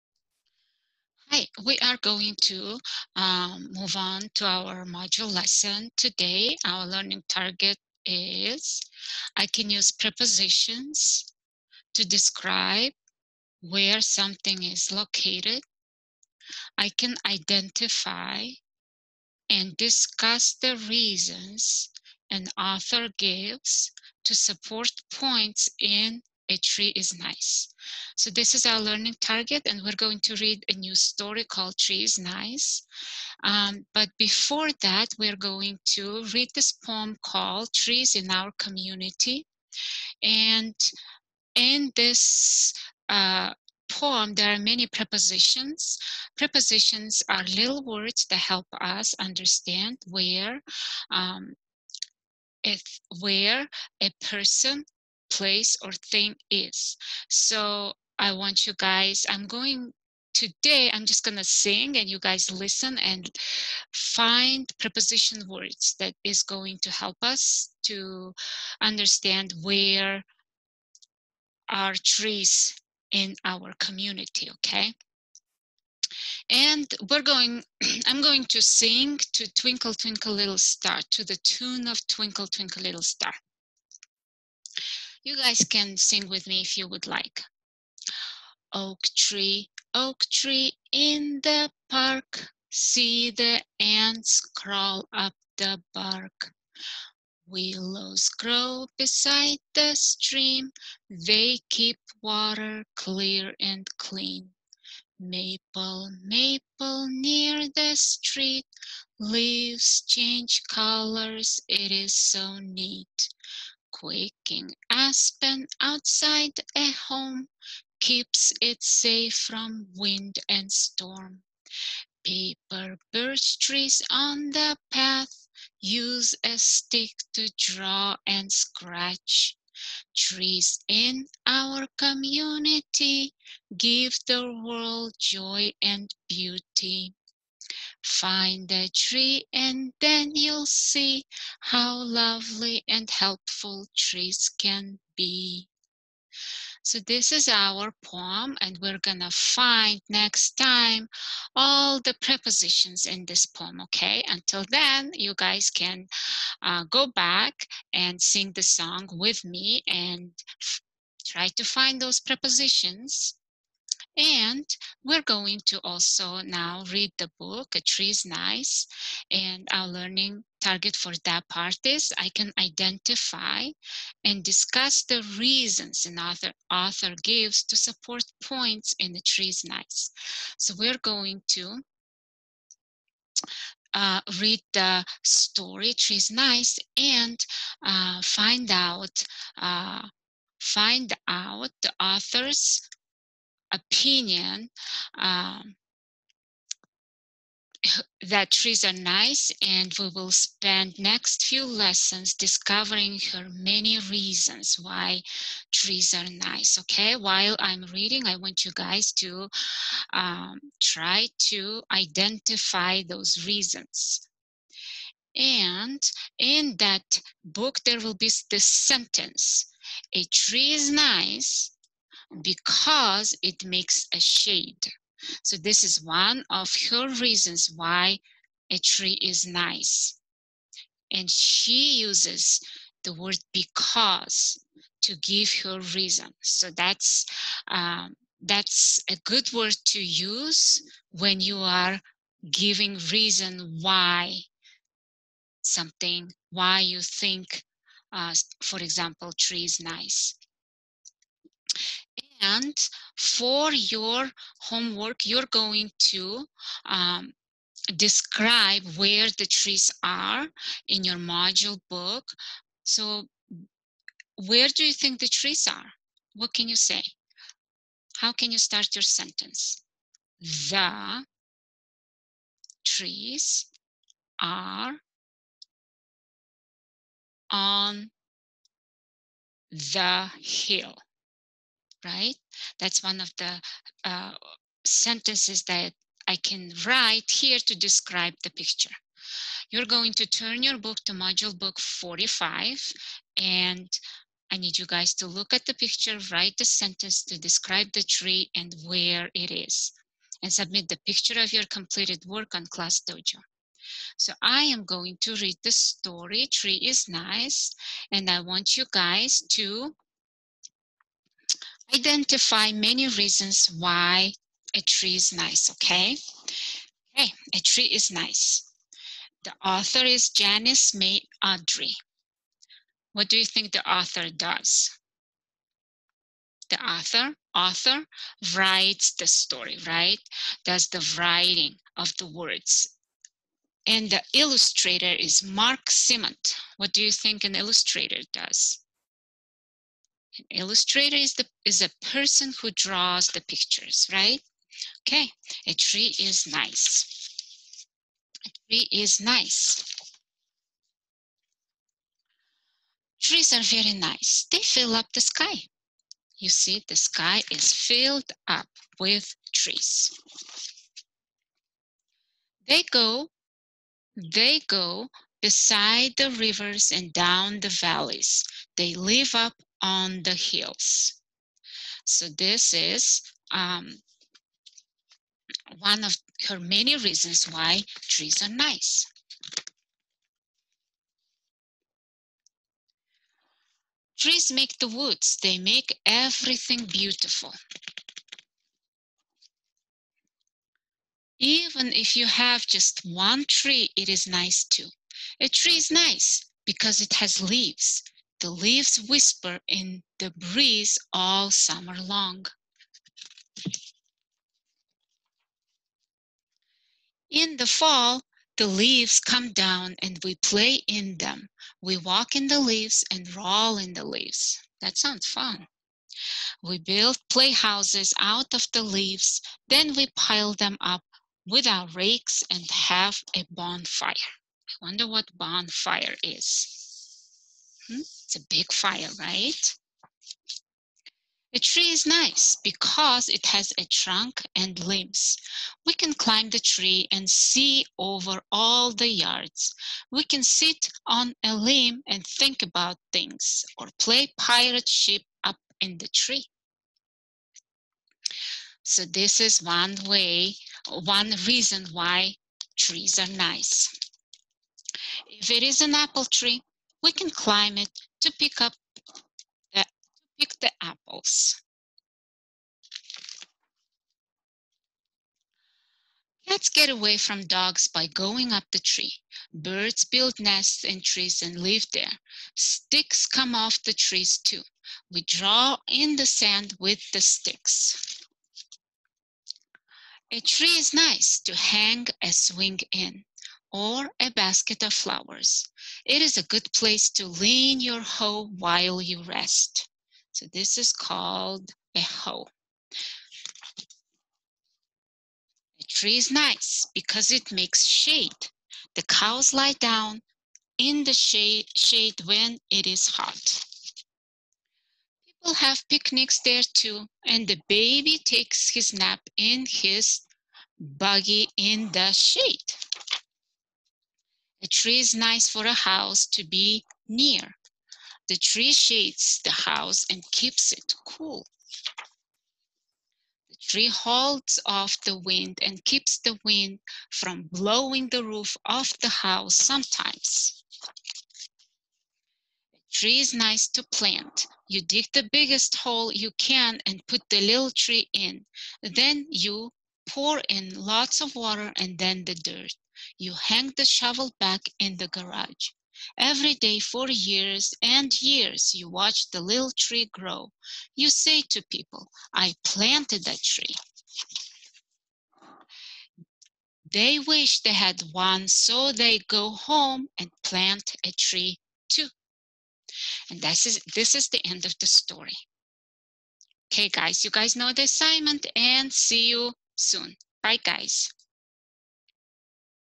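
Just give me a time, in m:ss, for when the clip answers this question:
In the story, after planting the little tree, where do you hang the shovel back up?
9:05.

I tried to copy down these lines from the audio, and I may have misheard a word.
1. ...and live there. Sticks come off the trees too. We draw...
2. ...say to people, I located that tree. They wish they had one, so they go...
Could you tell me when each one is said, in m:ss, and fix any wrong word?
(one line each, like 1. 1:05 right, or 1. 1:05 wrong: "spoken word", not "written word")
1. 7:51 right
2. 9:11 wrong: "planted", not "located".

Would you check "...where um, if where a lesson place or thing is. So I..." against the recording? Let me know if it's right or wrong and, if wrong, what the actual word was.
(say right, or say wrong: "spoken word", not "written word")
wrong: "person", not "lesson".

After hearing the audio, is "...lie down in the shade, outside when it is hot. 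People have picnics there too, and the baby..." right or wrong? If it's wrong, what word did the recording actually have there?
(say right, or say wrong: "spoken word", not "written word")
wrong: "shade", not "outside".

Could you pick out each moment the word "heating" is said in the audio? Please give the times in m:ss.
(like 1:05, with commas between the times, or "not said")
not said.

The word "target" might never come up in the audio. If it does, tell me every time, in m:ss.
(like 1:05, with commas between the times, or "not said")
0:07, 0:29, 2:50.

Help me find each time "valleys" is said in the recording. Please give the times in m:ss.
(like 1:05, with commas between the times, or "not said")
6:07.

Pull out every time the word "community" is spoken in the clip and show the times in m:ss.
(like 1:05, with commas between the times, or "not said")
0:38, 1:13, 2:11.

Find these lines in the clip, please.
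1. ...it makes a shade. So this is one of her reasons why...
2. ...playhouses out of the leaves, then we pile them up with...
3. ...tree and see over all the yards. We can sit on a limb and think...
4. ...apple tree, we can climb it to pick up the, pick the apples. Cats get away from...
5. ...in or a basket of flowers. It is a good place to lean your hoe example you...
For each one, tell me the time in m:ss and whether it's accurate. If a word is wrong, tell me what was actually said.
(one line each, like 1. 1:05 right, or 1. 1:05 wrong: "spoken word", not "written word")
1. 3:43 right
2. 6:57 right
3. 7:16 right
4. 7:35 right
5. 8:02 wrong: "while", not "example".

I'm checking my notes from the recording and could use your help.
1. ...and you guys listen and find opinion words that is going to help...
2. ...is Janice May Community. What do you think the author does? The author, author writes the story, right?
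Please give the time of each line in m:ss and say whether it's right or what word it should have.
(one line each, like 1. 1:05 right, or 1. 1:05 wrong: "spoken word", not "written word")
1. 1:01 wrong: "preposition", not "opinion"
2. 5:20 wrong: "Udry", not "Community".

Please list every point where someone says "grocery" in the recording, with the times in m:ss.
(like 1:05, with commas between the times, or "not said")
not said.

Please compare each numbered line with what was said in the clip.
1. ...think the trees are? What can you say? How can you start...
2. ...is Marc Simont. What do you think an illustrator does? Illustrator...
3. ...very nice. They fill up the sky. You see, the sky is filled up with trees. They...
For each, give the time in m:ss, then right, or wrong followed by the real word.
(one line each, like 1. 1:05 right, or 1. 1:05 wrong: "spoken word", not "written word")
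1. 4:24 right
2. 5:35 right
3. 5:53 right.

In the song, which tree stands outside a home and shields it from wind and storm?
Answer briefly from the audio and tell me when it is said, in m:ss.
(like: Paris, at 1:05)
quaking aspen, at 1:54.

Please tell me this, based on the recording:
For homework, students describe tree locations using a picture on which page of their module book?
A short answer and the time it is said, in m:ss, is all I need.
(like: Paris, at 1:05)
45, at 4:51.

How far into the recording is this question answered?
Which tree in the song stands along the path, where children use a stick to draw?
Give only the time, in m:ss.
2:02.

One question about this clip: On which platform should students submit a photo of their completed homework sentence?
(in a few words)
Class Dojo.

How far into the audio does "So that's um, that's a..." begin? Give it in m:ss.
3:56.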